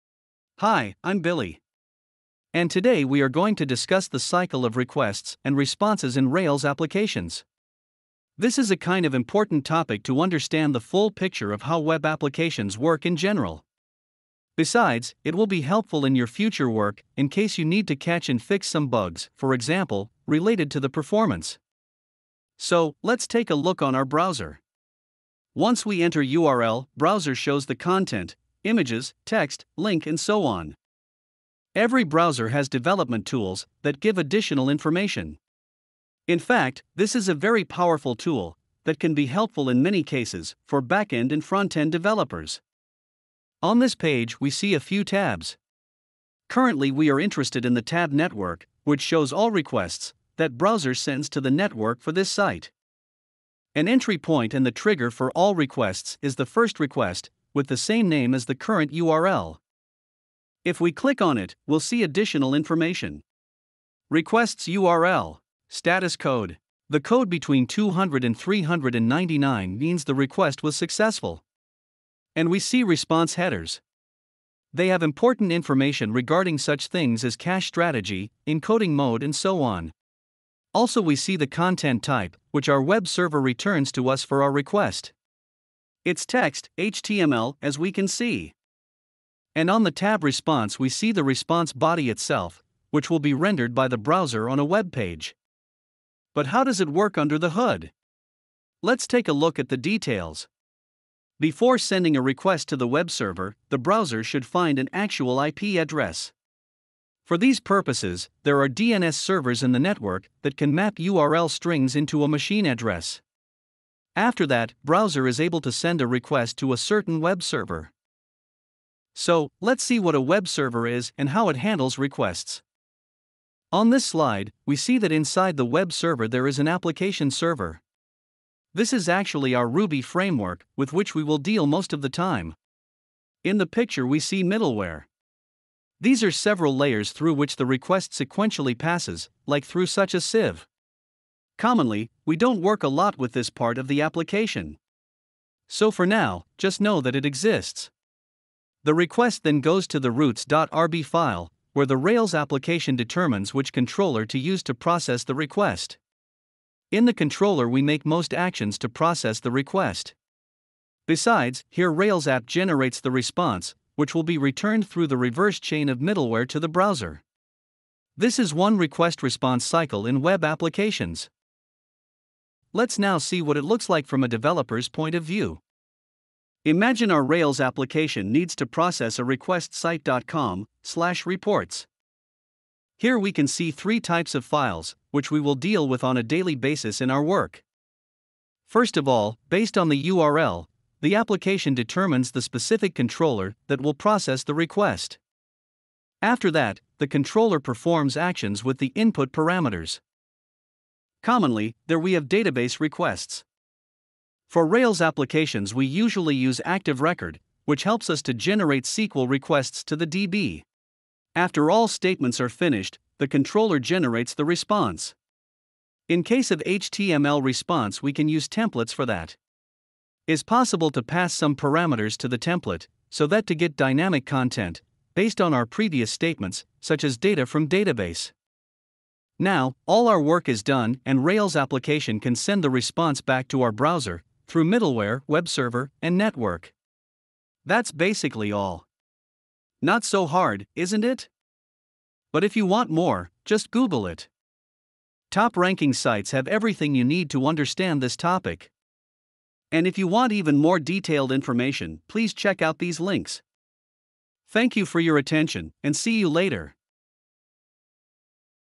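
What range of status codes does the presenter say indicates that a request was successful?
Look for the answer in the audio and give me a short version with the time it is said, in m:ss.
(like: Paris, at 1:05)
200 to 399, at 1:07.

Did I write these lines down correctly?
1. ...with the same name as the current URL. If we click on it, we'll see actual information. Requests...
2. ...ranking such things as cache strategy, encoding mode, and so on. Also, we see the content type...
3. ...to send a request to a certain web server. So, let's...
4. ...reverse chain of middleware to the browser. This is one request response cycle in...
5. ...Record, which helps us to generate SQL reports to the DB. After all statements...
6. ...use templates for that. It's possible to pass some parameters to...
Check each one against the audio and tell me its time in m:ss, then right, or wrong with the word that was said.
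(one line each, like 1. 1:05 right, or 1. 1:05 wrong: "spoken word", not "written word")
1. 0:57 wrong: "additional", not "actual"
2. 1:16 wrong: "regarding", not "ranking"
3. 1:55 right
4. 2:45 right
5. 3:26 wrong: "requests", not "reports"
6. 3:38 right.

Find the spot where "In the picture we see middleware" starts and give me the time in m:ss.
2:13.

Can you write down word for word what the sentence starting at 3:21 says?
Commonly, there we have database requests.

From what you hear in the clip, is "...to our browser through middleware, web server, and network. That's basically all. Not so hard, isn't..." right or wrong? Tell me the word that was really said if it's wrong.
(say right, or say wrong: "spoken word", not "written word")
right.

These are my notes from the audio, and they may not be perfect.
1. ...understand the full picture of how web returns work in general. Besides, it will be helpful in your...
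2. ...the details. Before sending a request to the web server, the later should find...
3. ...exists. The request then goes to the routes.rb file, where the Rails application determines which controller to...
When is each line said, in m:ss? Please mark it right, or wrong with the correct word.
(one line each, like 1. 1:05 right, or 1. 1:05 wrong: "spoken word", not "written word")
1. 0:10 wrong: "applications", not "returns"
2. 1:39 wrong: "browser", not "later"
3. 2:27 right.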